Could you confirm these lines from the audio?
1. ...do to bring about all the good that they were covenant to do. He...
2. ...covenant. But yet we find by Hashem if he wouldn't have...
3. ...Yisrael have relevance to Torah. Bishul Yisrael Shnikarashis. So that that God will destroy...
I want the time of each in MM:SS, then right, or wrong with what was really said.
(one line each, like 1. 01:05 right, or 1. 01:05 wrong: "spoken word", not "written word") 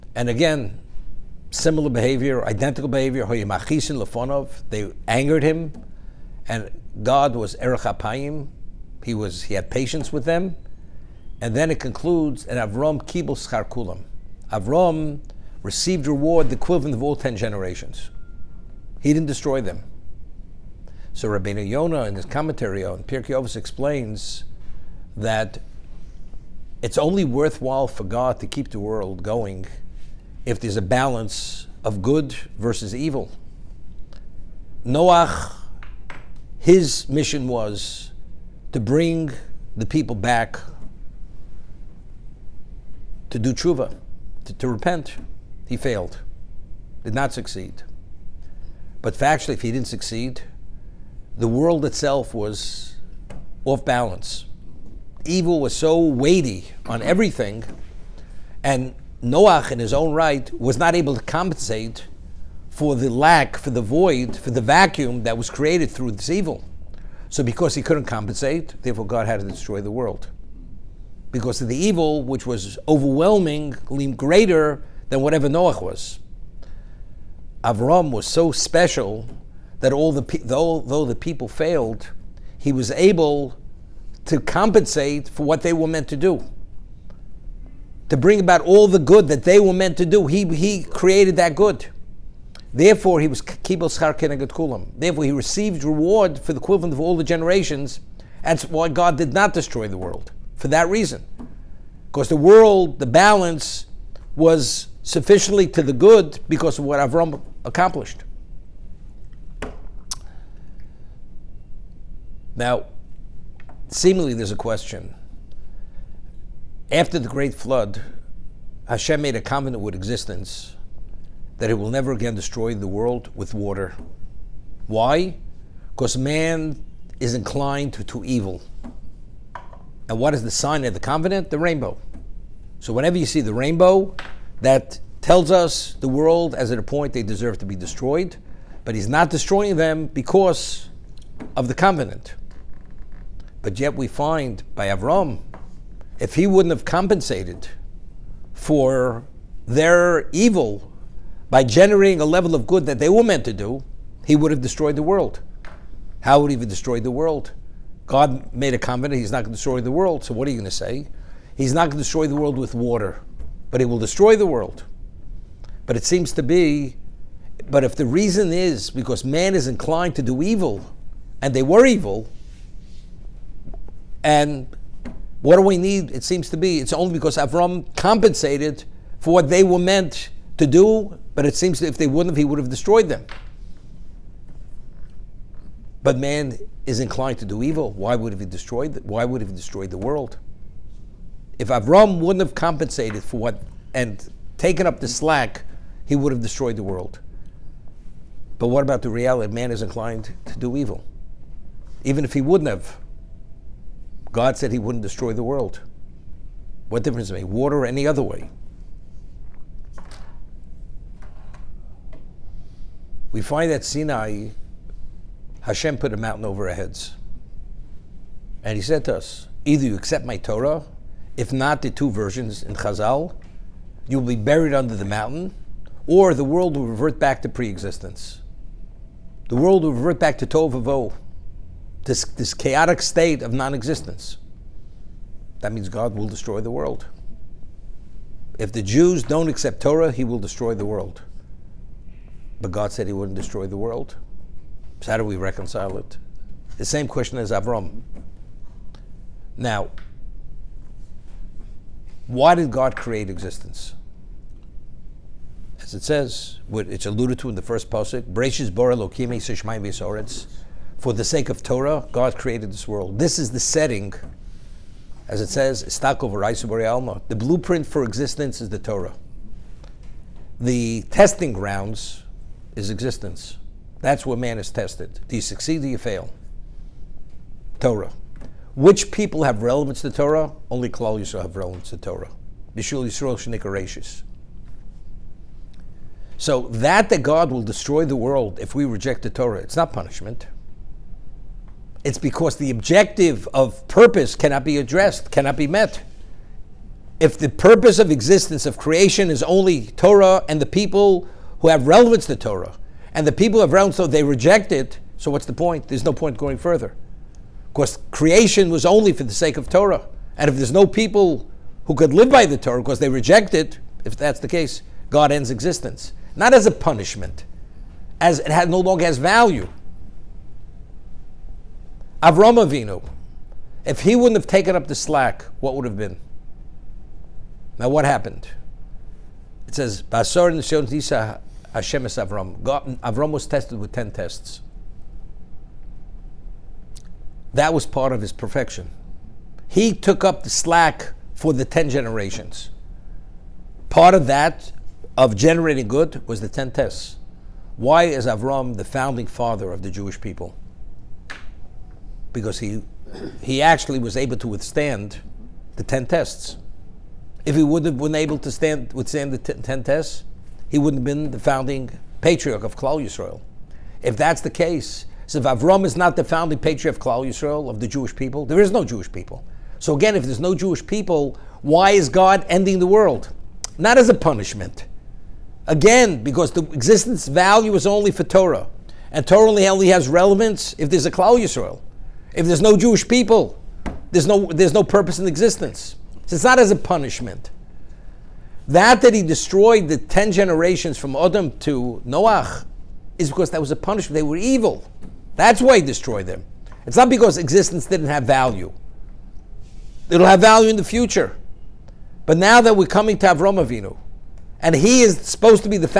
1. 01:26 wrong: "meant", not "covenant"
2. 02:21 wrong: "Avram", not "Hashem"
3. 04:41 right.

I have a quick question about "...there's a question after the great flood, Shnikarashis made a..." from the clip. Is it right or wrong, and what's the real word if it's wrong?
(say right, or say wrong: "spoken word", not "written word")
wrong: "Hashem", not "Shnikarashis".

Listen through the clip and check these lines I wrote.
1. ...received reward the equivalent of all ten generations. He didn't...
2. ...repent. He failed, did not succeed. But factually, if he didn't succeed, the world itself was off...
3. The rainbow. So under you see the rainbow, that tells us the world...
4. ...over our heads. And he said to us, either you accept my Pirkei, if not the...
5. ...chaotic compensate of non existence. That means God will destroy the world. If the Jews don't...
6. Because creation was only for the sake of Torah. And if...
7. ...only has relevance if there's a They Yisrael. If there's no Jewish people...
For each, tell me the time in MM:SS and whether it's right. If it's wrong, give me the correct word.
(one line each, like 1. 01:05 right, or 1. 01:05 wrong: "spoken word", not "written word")
1. 00:15 right
2. 00:44 right
3. 02:11 wrong: "whenever", not "under"
4. 03:36 wrong: "Torah", not "Pirkei"
5. 03:52 wrong: "state", not "compensate"
6. 05:07 right
7. 06:19 wrong: "Klal", not "They".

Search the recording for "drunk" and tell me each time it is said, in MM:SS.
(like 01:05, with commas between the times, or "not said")
not said.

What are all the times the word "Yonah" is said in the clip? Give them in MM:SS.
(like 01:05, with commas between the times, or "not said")
00:21.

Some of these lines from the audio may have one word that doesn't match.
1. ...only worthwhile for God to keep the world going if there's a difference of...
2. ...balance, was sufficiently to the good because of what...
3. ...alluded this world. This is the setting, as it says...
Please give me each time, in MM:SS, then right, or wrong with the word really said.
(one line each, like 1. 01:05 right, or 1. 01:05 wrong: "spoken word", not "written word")
1. 00:26 wrong: "balance", not "difference"
2. 01:43 right
3. 04:22 wrong: "created", not "alluded".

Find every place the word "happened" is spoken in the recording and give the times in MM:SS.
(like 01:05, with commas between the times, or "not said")
05:28.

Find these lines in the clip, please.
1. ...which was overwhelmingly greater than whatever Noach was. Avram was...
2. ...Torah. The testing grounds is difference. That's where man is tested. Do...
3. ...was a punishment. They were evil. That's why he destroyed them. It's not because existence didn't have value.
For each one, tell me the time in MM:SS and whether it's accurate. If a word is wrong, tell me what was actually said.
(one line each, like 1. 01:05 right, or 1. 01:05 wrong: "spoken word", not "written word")
1. 01:12 right
2. 04:28 wrong: "existence", not "difference"
3. 06:33 right.